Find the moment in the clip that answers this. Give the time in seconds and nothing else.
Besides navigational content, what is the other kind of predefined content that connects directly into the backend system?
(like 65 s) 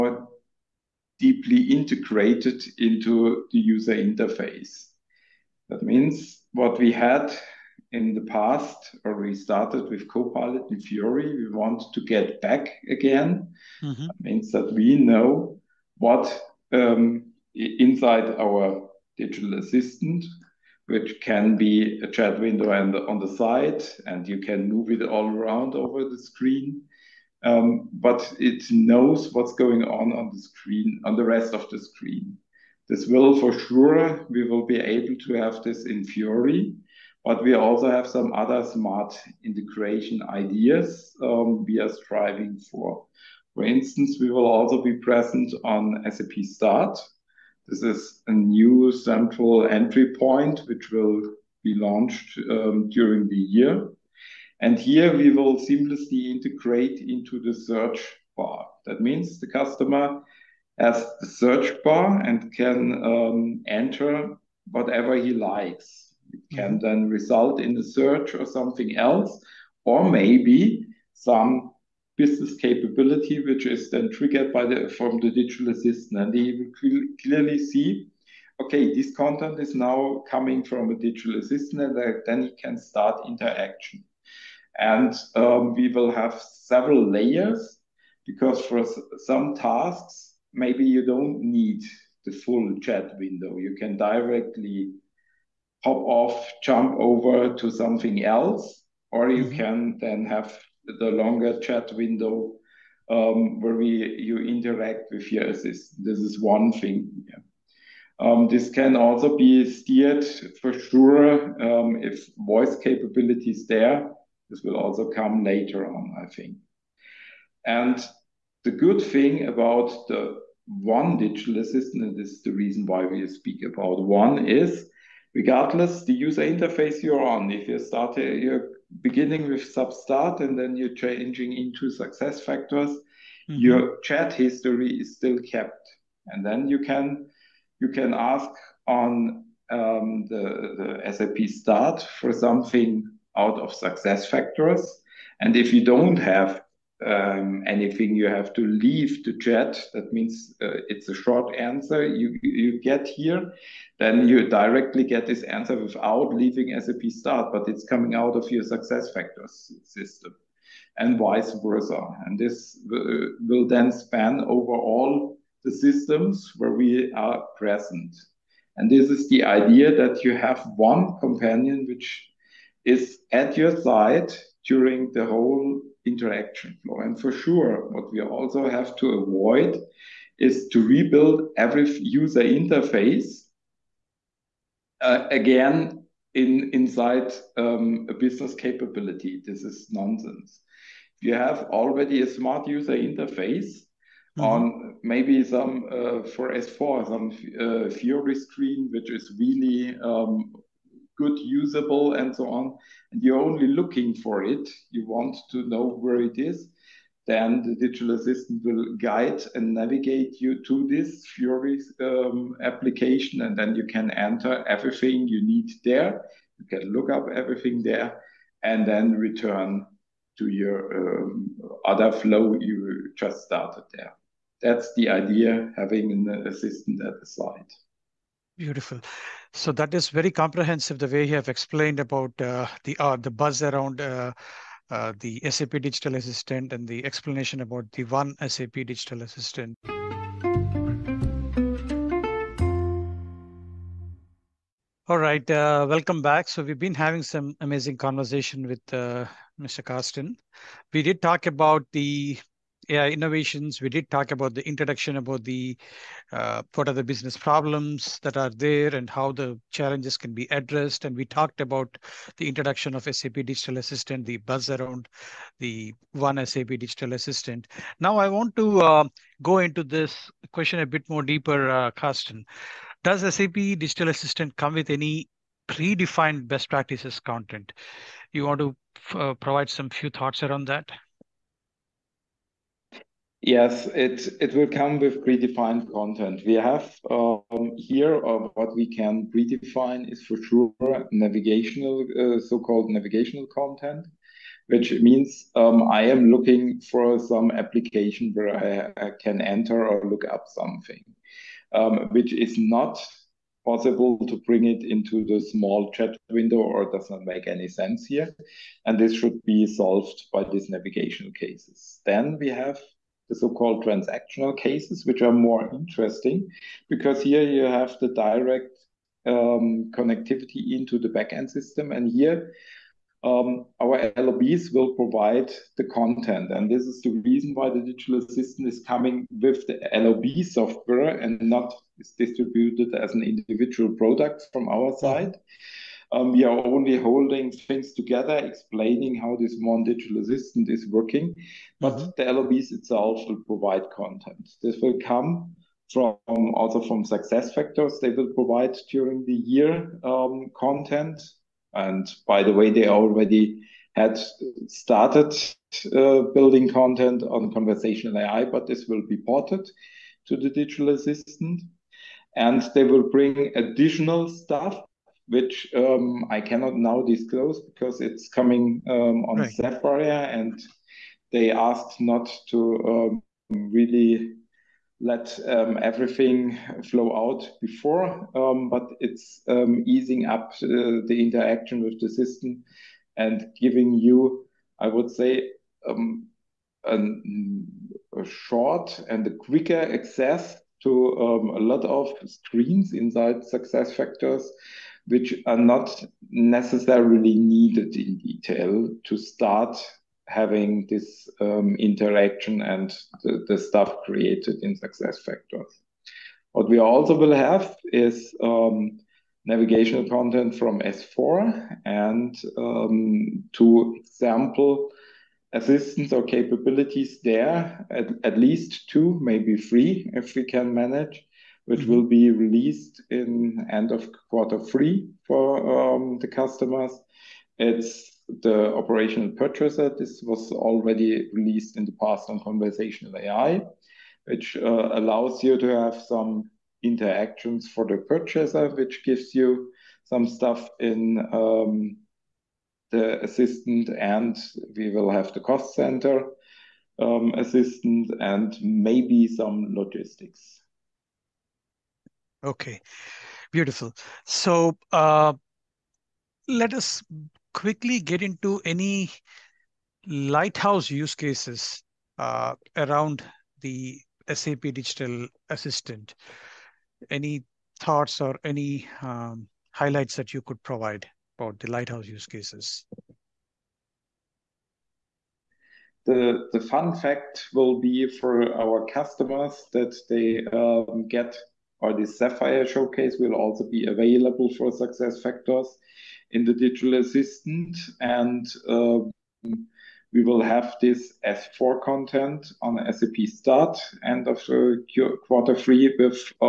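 313 s.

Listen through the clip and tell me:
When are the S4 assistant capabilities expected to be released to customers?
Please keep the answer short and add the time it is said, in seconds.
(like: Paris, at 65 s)
end of quarter three, at 423 s.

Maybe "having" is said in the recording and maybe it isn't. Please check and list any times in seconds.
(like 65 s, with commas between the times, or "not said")
225 s, 247 s, 400 s.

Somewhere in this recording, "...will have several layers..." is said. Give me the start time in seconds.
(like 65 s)
85 s.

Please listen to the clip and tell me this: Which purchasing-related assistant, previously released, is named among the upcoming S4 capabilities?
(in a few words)
operational purchaser.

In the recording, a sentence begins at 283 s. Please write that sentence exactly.
Yes, it will come with predefined content.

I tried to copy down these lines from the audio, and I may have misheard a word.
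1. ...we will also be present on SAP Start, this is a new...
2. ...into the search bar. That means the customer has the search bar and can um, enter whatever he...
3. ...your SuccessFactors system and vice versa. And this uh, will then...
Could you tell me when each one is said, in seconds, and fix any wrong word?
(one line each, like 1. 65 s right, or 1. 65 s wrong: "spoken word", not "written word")
1. 44 s right
2. 57 s right
3. 158 s right.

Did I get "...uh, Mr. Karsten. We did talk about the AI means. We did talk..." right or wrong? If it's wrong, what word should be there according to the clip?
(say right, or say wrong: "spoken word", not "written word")
wrong: "innovations", not "means".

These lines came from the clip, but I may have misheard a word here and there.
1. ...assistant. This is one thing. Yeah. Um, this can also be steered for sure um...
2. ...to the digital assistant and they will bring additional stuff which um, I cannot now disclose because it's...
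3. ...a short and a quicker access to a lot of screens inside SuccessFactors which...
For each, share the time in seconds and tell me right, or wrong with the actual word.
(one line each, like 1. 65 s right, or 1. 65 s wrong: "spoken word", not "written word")
1. 105 s right
2. 360 s right
3. 386 s right.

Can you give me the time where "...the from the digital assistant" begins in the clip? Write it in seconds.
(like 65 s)
74 s.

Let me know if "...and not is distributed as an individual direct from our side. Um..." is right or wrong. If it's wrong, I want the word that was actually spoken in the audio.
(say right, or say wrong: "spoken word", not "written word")
wrong: "product", not "direct".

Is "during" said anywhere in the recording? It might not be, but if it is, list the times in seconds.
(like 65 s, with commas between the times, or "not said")
52 s, 174 s, 348 s.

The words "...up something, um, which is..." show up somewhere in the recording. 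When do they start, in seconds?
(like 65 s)
300 s.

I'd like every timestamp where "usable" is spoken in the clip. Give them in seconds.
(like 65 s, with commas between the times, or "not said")
201 s.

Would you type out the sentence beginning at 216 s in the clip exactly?
You can look up everything there, and then return to your um, other flow you just started there.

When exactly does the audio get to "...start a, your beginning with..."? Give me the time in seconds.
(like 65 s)
127 s.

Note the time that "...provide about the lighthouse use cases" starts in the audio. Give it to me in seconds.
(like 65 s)
470 s.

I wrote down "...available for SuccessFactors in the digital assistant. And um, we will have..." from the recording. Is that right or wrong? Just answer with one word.
right.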